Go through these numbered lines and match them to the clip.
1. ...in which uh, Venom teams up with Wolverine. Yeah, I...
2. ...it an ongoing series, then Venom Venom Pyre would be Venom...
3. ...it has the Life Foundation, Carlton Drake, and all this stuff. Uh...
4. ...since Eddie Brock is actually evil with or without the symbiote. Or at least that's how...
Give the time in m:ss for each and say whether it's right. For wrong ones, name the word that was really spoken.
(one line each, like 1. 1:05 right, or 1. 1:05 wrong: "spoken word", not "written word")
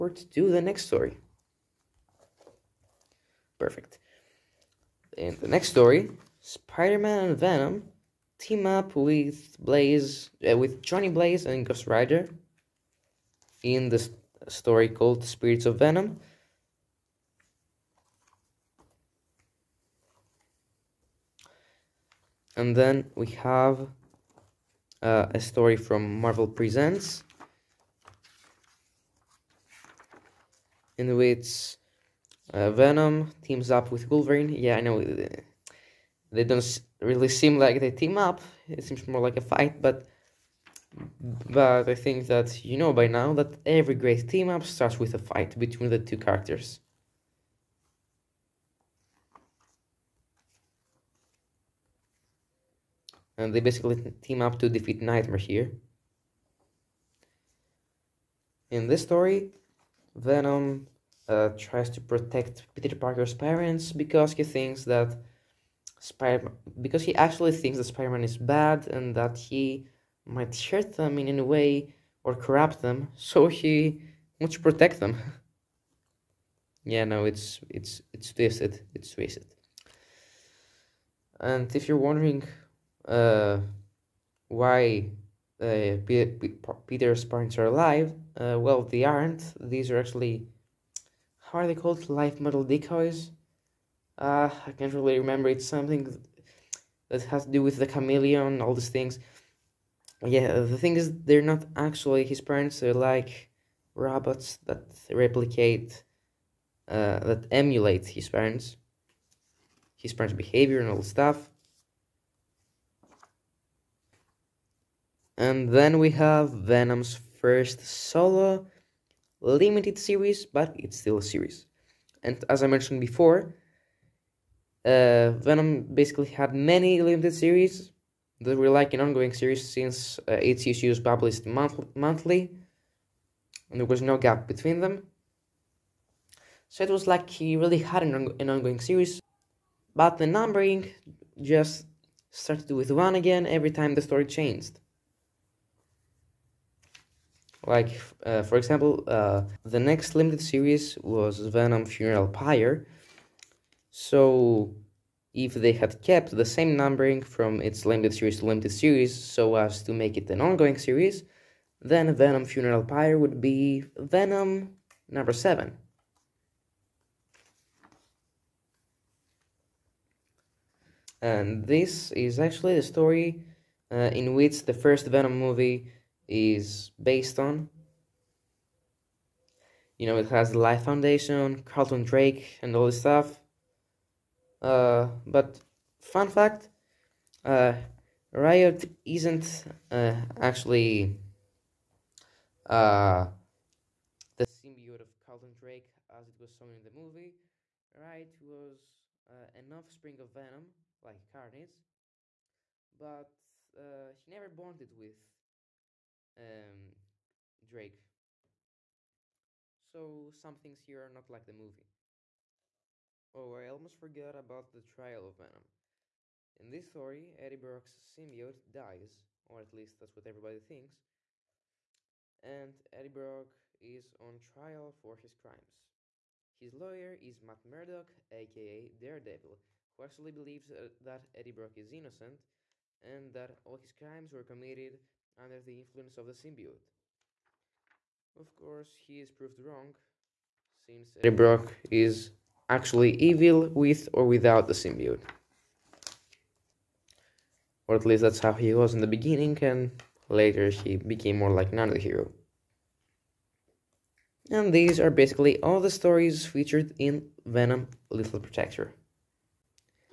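1. 0:30 right
2. 2:40 wrong: "Funeral", not "Venom"
3. 3:00 right
4. 4:00 right.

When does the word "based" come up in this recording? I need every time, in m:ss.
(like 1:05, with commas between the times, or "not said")
2:57.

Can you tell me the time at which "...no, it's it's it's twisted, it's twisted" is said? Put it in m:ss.
1:17.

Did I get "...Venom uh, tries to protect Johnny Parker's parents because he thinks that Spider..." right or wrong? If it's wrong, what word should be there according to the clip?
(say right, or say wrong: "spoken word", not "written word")
wrong: "Peter", not "Johnny".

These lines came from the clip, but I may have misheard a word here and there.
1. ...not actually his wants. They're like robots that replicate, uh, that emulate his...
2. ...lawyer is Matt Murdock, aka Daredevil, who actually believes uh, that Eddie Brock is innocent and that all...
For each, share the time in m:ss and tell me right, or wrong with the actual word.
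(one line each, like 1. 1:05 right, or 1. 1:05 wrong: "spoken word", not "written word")
1. 1:41 wrong: "parents", not "wants"
2. 3:46 right.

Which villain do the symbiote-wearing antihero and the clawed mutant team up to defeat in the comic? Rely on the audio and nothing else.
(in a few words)
Nightmare.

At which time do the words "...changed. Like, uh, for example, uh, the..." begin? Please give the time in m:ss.
2:24.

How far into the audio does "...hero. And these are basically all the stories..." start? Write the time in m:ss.
4:11.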